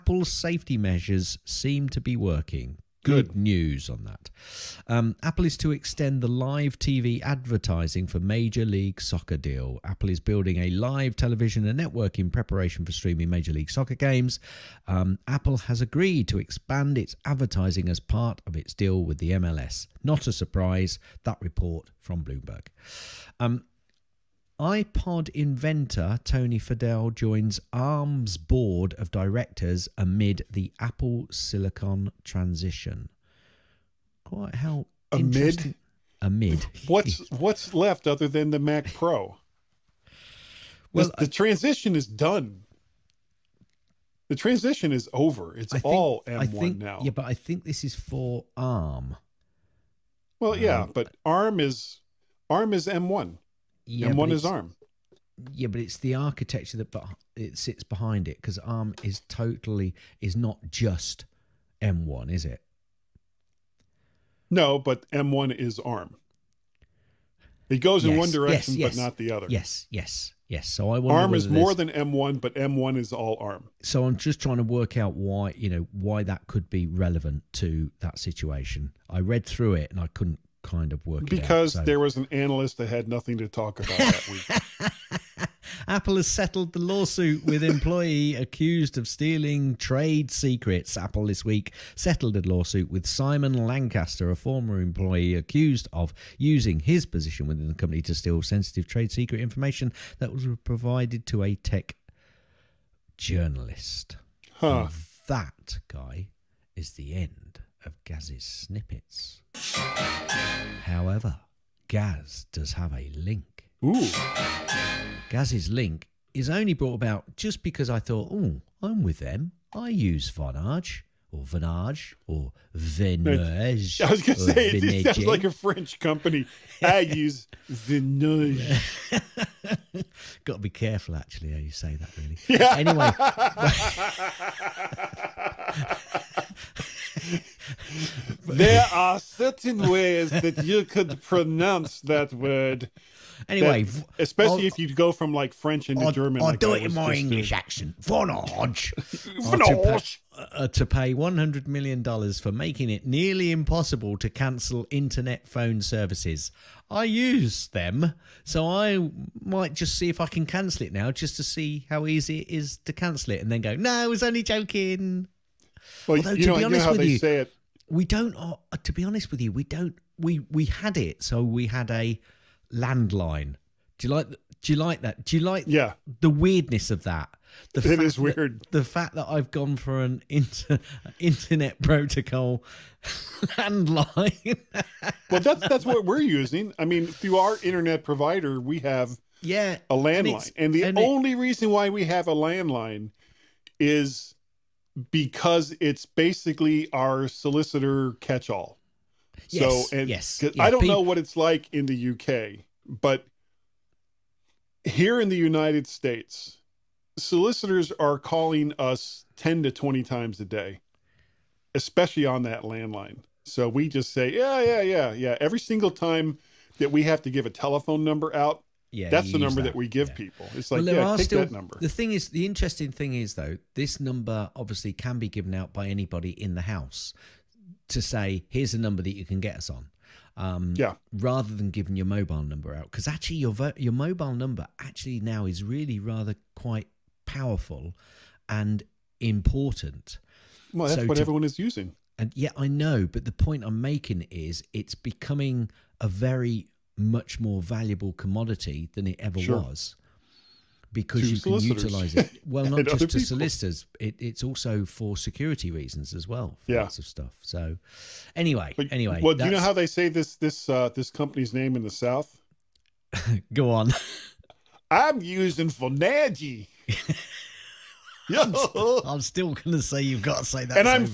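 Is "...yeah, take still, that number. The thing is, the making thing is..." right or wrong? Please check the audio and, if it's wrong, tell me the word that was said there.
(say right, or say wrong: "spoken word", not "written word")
wrong: "interesting", not "making".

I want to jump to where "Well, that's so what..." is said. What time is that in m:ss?
4:00.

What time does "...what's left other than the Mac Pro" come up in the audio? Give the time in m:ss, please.
0:37.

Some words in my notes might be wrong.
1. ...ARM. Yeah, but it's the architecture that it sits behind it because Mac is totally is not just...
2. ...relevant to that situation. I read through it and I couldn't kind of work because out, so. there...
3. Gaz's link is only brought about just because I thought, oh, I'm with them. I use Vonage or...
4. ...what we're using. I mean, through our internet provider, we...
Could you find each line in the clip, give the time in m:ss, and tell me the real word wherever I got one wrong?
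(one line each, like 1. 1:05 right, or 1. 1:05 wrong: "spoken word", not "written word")
1. 0:54 wrong: "ARM", not "Mac"
2. 1:16 right
3. 1:55 right
4. 3:05 right.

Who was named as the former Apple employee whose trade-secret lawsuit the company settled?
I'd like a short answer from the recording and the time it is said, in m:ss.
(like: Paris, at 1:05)
Simon Lancaster, at 1:33.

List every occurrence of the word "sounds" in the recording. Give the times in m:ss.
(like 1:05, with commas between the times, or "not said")
2:05.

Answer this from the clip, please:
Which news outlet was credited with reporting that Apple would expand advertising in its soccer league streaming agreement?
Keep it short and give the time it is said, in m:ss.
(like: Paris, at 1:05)
Bloomberg, at 0:22.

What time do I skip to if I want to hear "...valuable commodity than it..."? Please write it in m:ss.
4:07.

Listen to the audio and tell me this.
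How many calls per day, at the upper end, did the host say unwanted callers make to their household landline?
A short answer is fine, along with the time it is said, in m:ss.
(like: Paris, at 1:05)
20, at 3:29.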